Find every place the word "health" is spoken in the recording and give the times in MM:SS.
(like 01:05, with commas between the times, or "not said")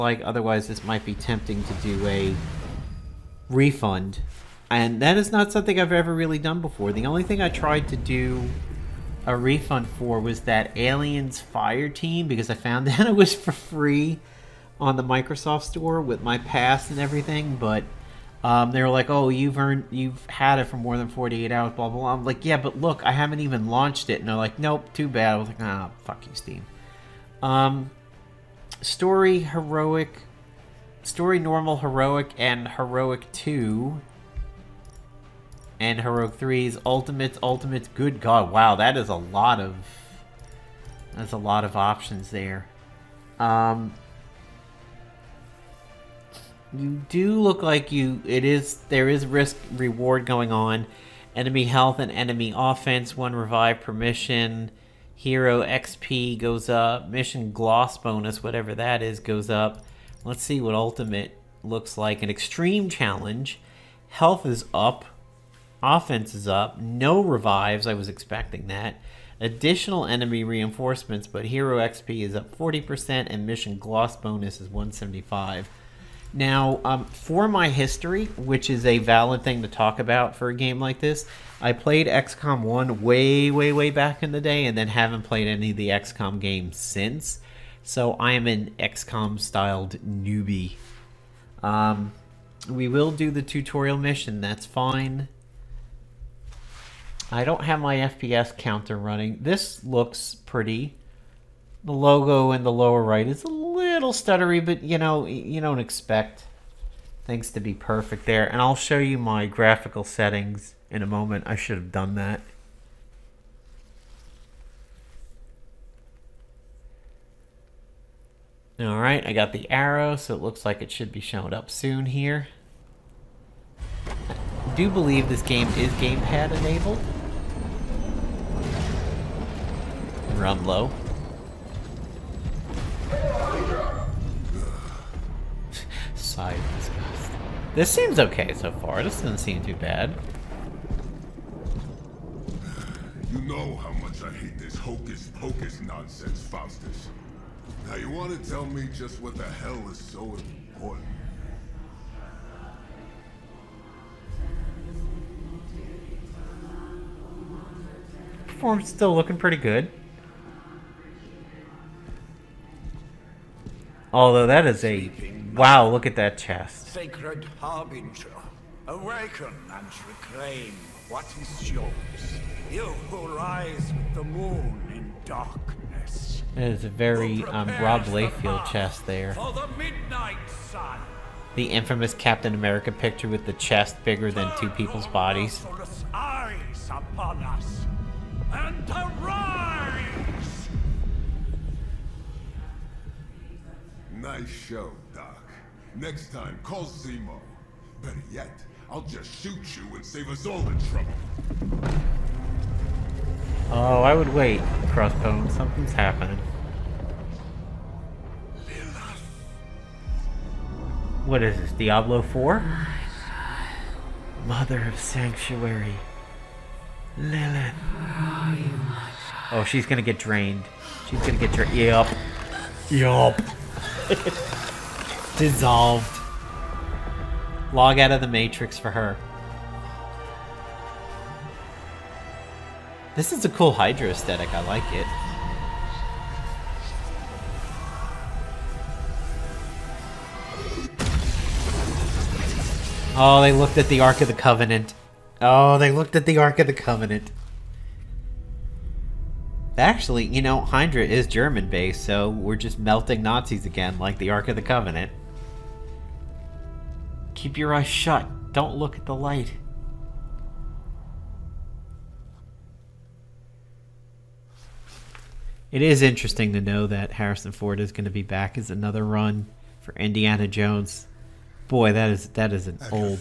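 00:51, 01:04.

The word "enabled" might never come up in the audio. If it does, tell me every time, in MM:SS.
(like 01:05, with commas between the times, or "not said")
02:06.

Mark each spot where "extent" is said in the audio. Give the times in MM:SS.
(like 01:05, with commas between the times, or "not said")
not said.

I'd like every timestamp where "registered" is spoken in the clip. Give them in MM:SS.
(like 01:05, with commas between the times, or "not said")
not said.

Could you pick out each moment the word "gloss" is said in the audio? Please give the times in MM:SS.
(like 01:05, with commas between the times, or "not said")
00:57, 01:13.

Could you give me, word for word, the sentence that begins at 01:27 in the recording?
So I am an XCOM styled newbie.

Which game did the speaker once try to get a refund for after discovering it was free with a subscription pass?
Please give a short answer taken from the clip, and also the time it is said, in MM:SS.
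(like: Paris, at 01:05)
Aliens Fire Team, at 00:10.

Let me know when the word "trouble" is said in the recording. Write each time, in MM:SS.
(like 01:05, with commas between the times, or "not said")
03:20.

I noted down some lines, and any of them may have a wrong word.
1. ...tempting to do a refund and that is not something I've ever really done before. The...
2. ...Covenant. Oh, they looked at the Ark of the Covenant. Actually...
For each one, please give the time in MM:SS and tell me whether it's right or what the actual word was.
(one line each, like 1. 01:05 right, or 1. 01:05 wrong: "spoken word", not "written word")
1. 00:01 right
2. 04:04 right.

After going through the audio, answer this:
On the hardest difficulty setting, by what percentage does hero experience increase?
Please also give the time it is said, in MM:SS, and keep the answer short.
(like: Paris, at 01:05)
40%, at 01:12.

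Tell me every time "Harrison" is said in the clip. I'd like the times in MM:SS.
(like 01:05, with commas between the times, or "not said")
04:27.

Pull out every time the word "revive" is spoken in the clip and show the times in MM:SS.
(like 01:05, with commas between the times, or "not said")
00:53, 01:07.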